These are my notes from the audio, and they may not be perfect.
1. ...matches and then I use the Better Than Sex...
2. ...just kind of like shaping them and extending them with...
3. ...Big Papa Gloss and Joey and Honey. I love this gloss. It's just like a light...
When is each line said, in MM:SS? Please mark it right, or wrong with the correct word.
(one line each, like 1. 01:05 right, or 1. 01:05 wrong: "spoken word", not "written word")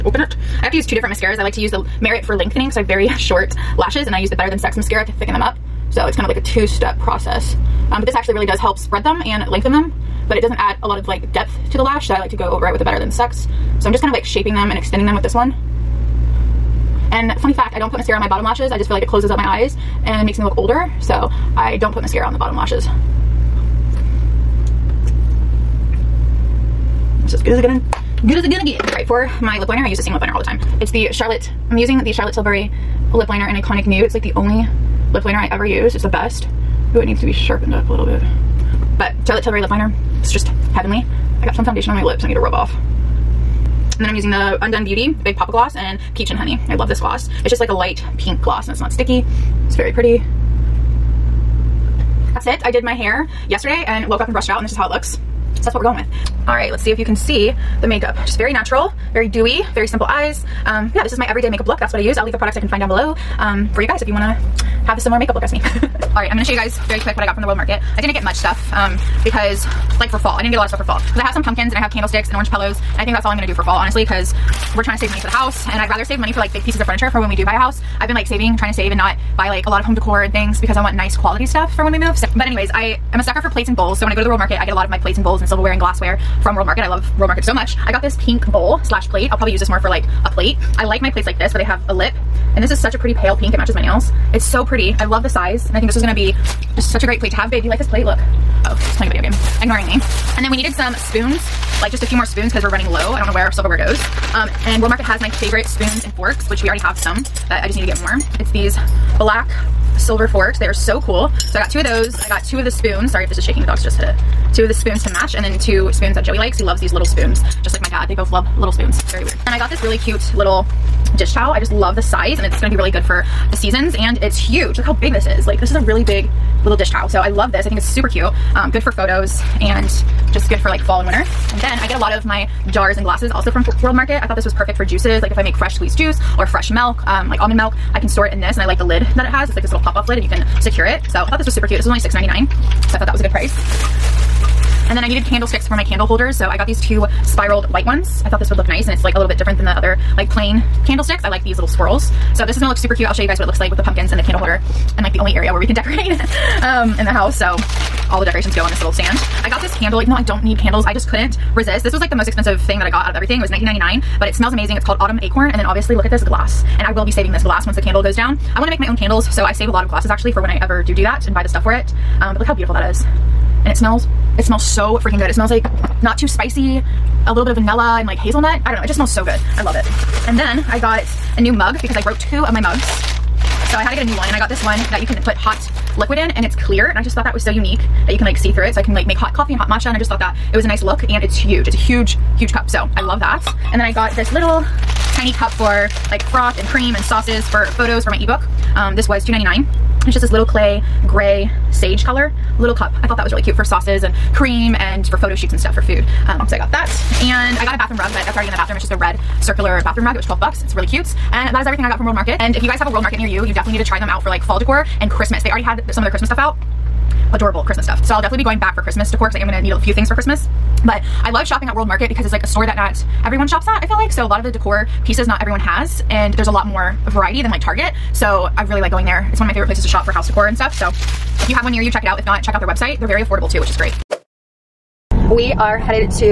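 1. 00:03 wrong: "lashes", not "matches"
2. 00:13 right
3. 00:45 wrong: "Peach", not "Joey".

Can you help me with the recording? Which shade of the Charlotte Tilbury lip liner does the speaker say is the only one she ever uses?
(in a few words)
Iconic Nude.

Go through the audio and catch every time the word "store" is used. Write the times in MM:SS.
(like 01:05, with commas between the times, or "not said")
02:18, 03:42.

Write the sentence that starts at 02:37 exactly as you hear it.
So all the decorations go on this little stand.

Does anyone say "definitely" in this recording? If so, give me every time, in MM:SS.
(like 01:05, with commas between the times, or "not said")
03:33, 03:38.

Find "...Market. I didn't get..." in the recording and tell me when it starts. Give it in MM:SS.
01:07.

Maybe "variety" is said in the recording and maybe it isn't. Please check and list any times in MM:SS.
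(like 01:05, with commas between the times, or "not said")
03:47.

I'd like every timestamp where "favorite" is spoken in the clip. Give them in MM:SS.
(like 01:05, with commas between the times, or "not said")
01:45, 03:49.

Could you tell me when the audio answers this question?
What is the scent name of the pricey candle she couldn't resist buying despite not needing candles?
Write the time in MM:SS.
02:44.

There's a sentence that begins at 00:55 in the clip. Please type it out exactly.
So that's what we're going with.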